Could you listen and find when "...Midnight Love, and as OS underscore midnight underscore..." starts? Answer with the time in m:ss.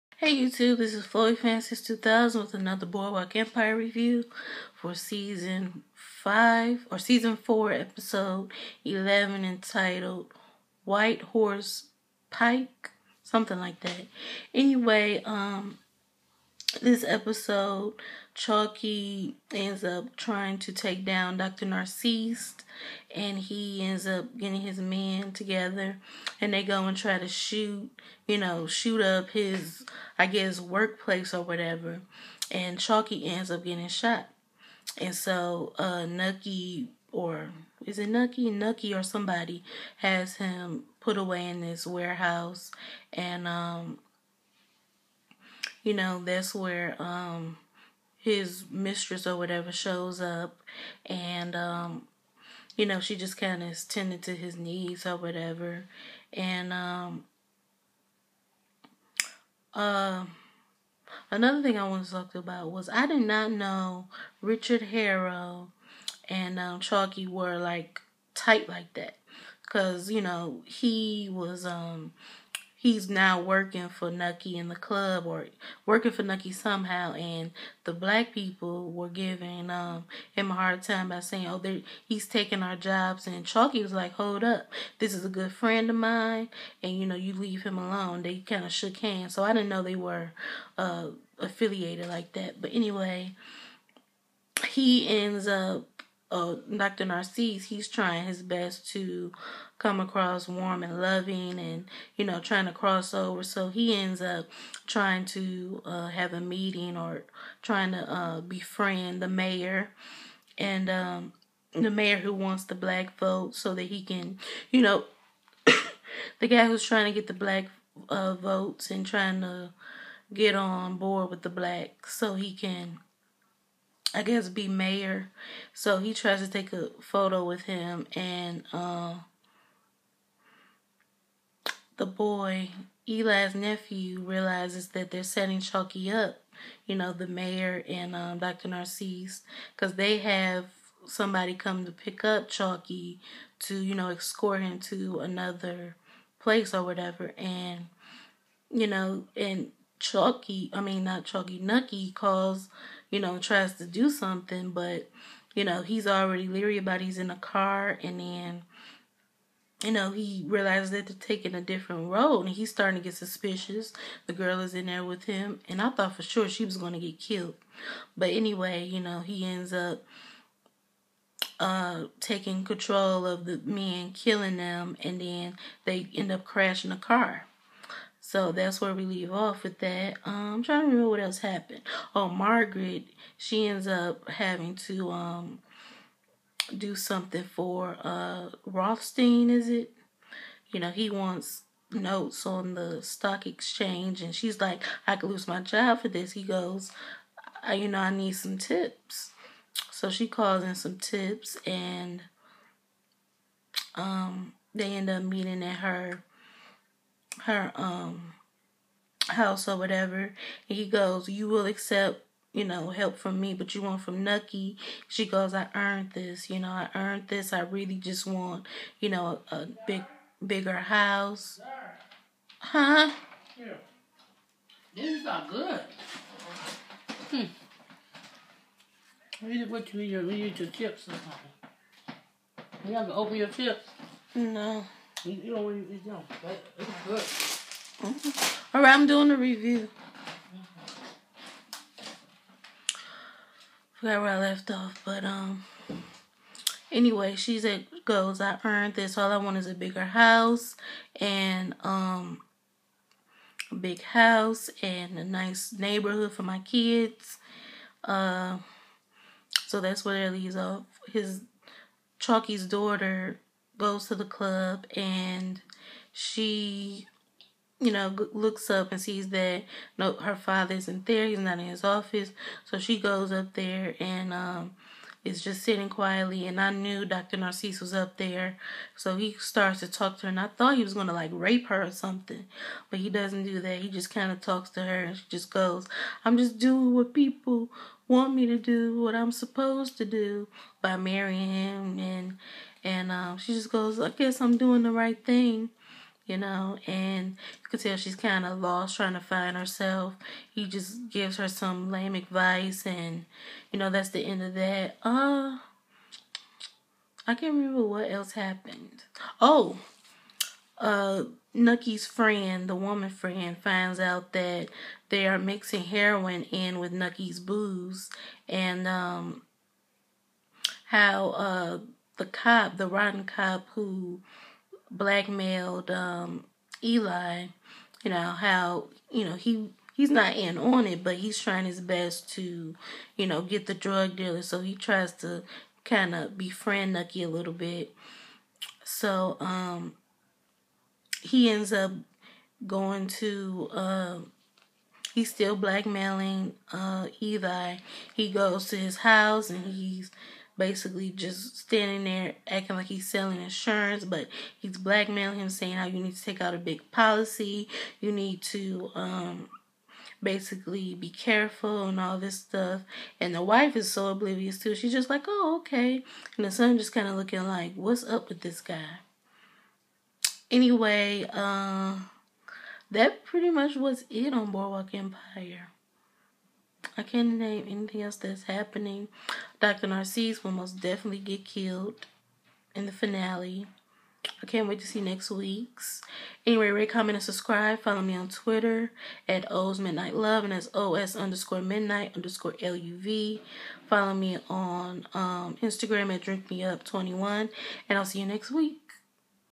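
6:29.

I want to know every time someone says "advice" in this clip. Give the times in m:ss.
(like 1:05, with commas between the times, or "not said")
5:02.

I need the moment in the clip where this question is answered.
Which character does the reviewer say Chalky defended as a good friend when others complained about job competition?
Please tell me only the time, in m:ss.
1:04.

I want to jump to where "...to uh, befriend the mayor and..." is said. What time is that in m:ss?
1:47.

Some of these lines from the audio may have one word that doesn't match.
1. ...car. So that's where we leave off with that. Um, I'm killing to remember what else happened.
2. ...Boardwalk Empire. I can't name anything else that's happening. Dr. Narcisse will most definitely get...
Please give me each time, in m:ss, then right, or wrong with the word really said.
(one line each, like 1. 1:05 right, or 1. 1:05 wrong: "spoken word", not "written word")
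1. 2:57 wrong: "trying", not "killing"
2. 6:14 right.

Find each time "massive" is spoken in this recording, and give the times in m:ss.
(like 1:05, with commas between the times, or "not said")
not said.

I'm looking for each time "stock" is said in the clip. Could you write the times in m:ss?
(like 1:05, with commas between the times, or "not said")
3:13.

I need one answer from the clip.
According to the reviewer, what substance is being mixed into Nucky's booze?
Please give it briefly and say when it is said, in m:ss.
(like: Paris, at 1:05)
Heroin, at 5:15.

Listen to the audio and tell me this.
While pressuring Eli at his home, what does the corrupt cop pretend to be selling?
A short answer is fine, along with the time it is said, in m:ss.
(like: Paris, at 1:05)
Insurance, at 5:53.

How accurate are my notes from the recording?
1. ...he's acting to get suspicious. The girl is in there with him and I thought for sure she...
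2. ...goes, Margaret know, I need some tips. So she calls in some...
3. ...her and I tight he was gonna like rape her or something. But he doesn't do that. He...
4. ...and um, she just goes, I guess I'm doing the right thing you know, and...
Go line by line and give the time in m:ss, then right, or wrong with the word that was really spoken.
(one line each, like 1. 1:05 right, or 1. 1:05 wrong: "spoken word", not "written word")
1. 2:42 wrong: "starting", not "acting"
2. 3:16 wrong: "You", not "Margaret"
3. 4:40 wrong: "thought", not "tight"
4. 4:52 right.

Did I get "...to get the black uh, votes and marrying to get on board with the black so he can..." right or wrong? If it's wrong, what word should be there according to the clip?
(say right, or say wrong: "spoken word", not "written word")
wrong: "trying", not "marrying".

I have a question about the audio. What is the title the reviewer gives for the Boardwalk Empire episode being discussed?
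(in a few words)
White Horse Pike.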